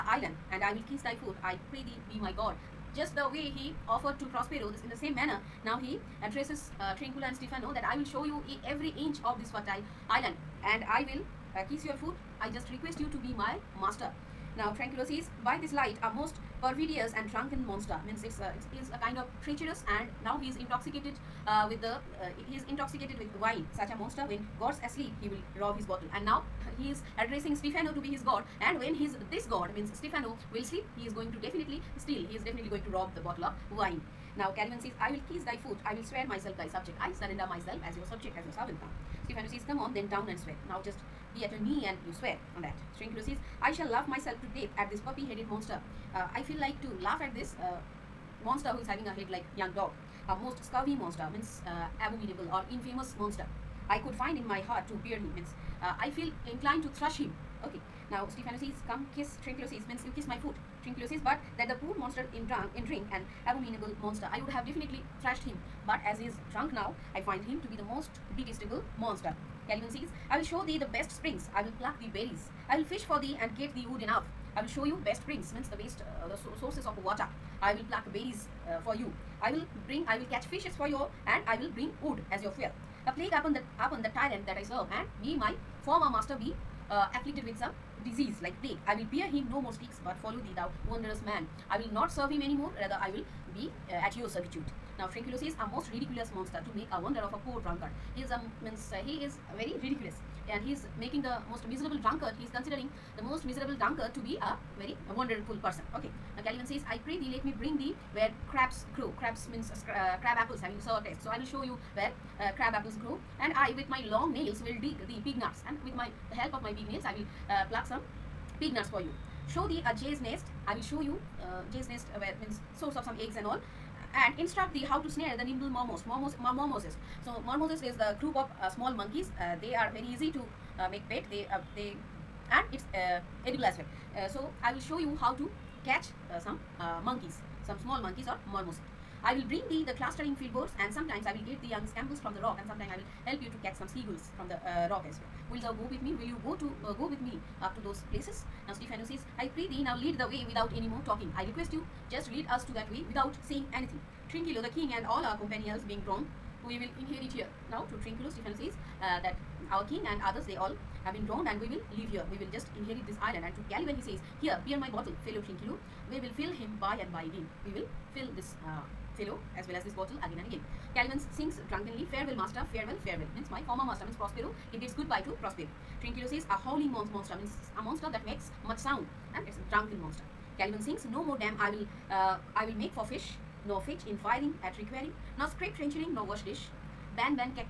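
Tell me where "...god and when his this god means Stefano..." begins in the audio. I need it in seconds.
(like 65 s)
28 s.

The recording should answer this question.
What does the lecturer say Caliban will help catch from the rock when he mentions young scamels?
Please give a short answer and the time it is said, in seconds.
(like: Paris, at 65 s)
Seagulls, at 143 s.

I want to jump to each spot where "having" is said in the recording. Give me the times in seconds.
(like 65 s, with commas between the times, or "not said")
48 s, 110 s.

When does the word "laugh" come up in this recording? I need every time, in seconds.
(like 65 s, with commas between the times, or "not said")
47 s.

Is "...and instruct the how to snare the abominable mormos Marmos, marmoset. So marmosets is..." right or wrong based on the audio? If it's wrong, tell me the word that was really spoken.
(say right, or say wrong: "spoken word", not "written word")
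wrong: "nimble", not "abominable".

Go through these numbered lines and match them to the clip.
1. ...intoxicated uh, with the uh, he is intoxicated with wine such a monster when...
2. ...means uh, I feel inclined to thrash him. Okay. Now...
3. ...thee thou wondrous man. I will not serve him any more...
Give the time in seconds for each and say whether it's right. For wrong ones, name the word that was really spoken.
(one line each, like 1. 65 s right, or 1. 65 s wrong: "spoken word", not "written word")
1. 20 s right
2. 55 s right
3. 90 s right.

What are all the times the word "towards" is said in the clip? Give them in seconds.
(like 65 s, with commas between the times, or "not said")
not said.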